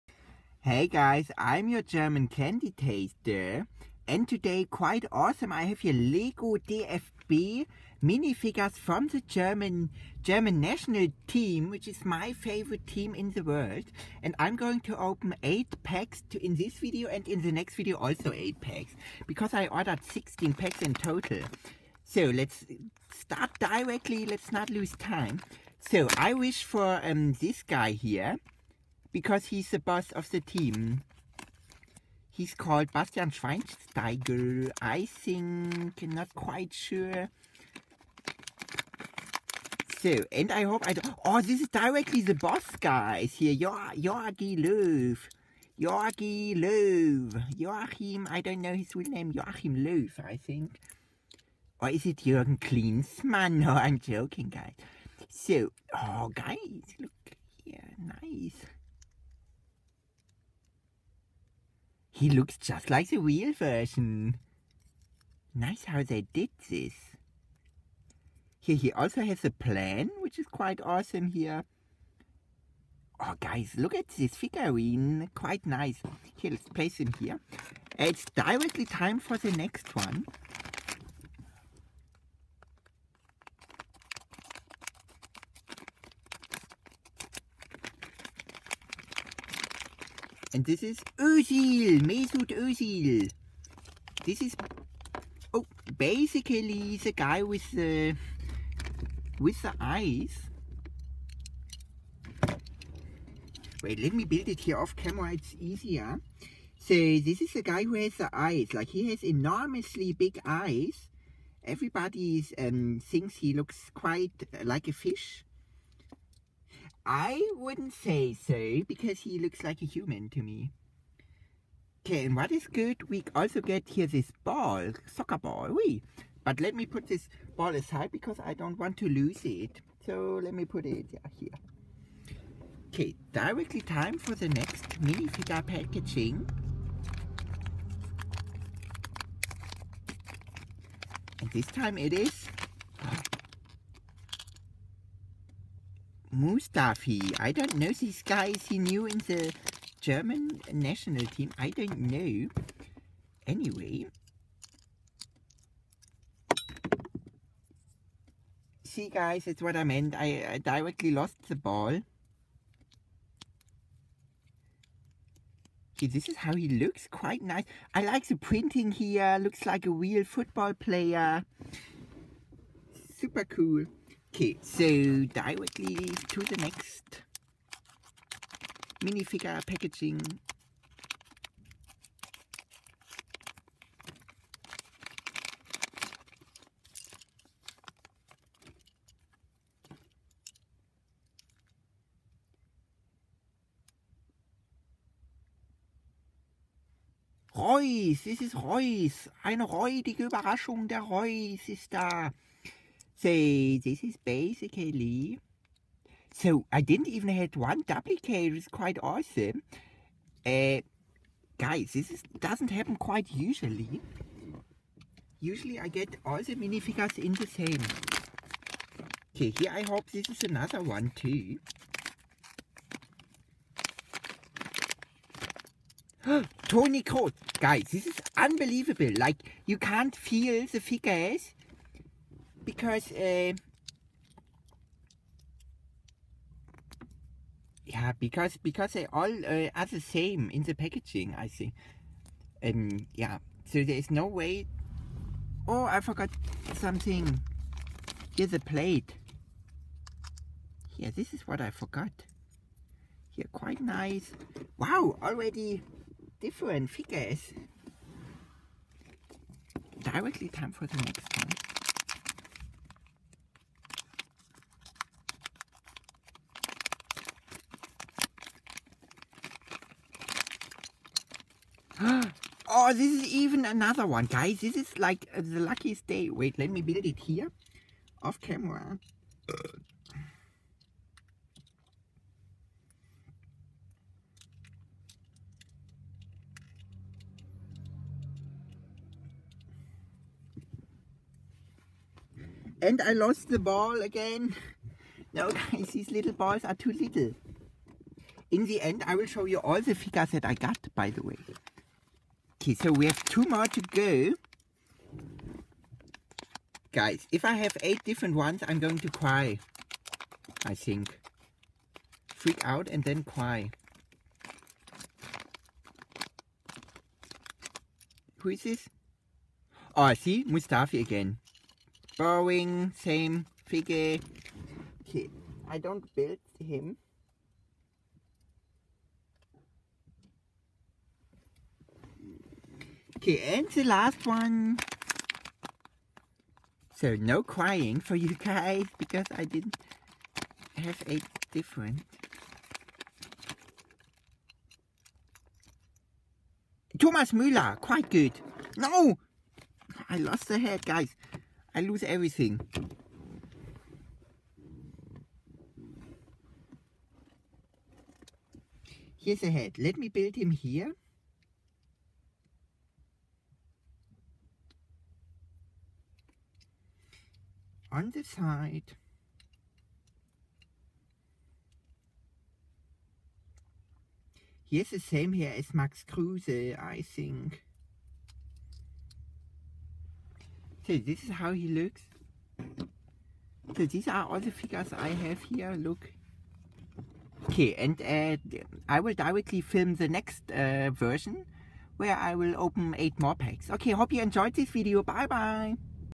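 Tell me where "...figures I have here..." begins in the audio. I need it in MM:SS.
06:24.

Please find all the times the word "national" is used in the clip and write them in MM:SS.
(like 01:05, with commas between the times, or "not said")
00:10, 02:30.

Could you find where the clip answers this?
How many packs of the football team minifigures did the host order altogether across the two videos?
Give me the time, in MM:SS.
00:20.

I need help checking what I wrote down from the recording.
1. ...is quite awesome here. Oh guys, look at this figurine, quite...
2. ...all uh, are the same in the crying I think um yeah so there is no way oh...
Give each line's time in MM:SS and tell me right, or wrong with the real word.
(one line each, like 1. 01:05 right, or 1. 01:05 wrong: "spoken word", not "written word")
1. 01:10 right
2. 03:59 wrong: "packaging", not "crying".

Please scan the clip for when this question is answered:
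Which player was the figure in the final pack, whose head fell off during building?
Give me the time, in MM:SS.
05:46.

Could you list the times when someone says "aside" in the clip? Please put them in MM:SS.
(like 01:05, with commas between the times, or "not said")
02:07.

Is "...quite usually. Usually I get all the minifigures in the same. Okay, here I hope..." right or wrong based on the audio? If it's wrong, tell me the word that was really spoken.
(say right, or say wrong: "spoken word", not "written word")
right.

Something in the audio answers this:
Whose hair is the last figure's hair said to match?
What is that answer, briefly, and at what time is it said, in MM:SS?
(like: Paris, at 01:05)
Max Kruse, at 06:15.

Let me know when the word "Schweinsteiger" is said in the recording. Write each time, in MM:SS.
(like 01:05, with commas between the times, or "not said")
00:33.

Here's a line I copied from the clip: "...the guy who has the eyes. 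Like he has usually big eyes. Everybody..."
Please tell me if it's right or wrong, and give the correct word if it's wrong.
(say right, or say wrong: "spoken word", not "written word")
wrong: "enormously", not "usually".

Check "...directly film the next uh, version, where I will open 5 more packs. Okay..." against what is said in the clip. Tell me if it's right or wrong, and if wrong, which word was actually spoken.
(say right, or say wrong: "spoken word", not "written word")
wrong: "8", not "5".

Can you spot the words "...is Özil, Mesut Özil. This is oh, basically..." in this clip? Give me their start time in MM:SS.
01:30.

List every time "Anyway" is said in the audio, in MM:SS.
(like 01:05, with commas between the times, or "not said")
02:33.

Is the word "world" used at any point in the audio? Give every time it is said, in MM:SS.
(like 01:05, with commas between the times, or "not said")
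00:13.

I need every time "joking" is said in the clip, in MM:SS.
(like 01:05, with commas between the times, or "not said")
00:53.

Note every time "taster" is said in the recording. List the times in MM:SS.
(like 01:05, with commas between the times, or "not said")
00:02.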